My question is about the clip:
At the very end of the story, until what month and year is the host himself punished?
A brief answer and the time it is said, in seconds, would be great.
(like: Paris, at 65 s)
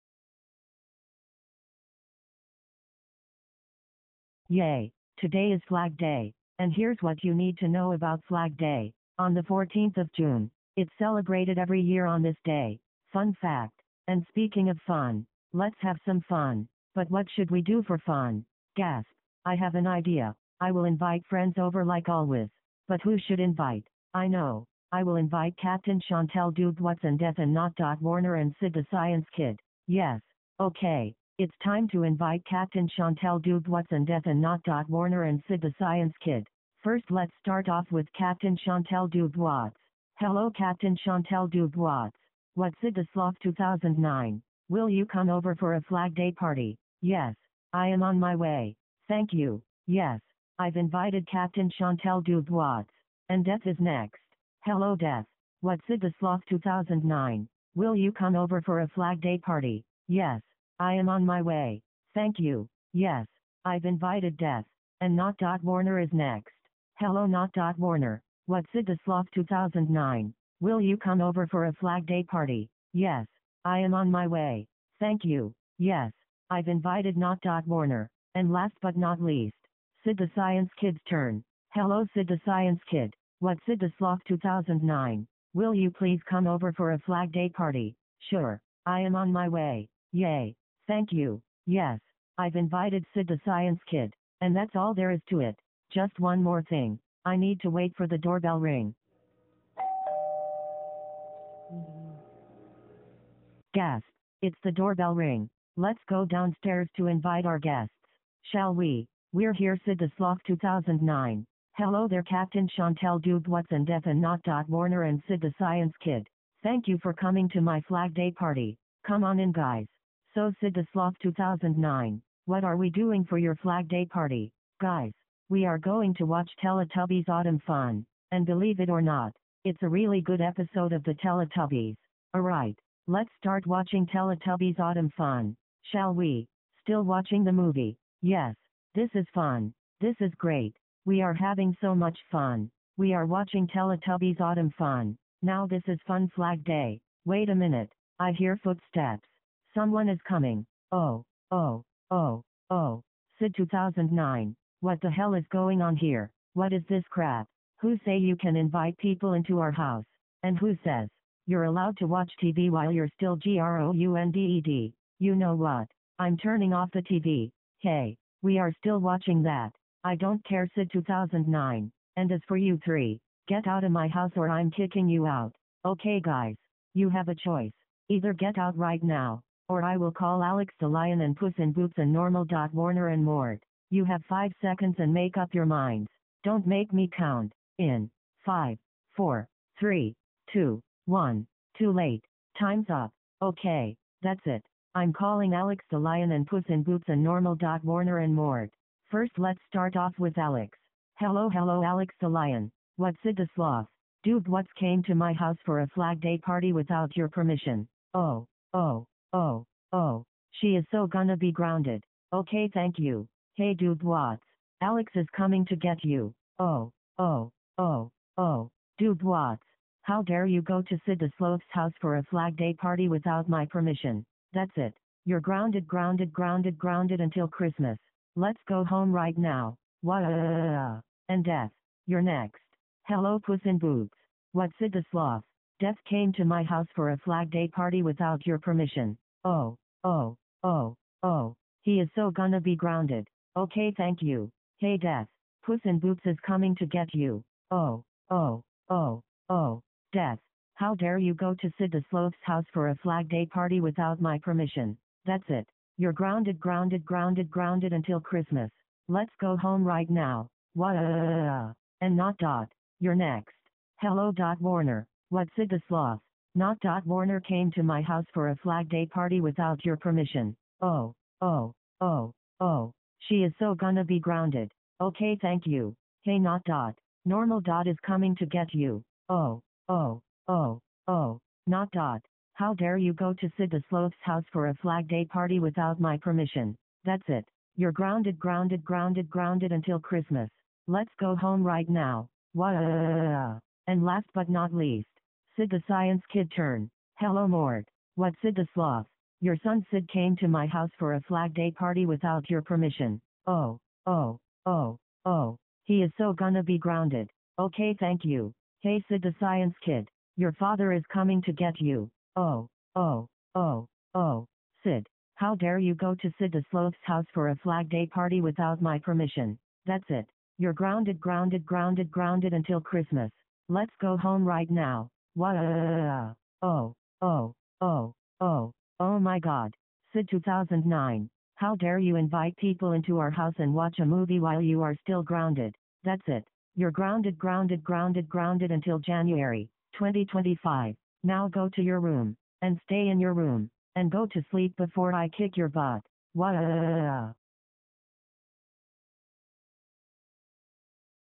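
January 2025, at 338 s.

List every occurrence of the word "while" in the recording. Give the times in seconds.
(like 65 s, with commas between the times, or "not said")
162 s, 334 s.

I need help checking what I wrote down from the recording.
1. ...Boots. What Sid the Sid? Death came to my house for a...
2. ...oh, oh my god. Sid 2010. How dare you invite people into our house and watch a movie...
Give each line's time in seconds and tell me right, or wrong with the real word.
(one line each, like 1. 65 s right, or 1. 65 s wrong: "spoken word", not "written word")
1. 233 s wrong: "Sloth", not "Sid"
2. 328 s wrong: "2009", not "2010".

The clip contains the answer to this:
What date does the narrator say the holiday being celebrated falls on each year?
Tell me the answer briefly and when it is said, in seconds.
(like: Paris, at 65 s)
June 14, at 9 s.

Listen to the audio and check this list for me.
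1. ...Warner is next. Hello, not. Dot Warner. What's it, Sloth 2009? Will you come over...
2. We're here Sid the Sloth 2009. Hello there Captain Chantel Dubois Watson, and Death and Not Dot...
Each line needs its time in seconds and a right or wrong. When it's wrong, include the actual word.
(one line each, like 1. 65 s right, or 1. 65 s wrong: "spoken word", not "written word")
1. 65 s right
2. 109 s right.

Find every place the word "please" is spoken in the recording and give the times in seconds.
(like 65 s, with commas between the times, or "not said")
85 s.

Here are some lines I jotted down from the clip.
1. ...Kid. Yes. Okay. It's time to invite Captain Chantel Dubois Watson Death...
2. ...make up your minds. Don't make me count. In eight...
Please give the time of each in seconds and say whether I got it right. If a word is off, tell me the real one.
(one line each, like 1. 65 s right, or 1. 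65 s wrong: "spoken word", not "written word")
1. 29 s right
2. 185 s wrong: "five", not "eight".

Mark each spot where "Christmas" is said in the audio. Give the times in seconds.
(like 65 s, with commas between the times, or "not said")
227 s, 258 s, 290 s, 322 s.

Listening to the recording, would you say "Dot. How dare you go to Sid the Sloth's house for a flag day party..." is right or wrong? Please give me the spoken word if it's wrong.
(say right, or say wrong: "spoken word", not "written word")
right.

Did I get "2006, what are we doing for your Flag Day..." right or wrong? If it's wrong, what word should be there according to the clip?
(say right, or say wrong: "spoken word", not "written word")
wrong: "2009", not "2006".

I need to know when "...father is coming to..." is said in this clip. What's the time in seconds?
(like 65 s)
310 s.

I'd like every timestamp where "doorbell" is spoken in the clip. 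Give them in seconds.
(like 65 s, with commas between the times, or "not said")
98 s, 104 s.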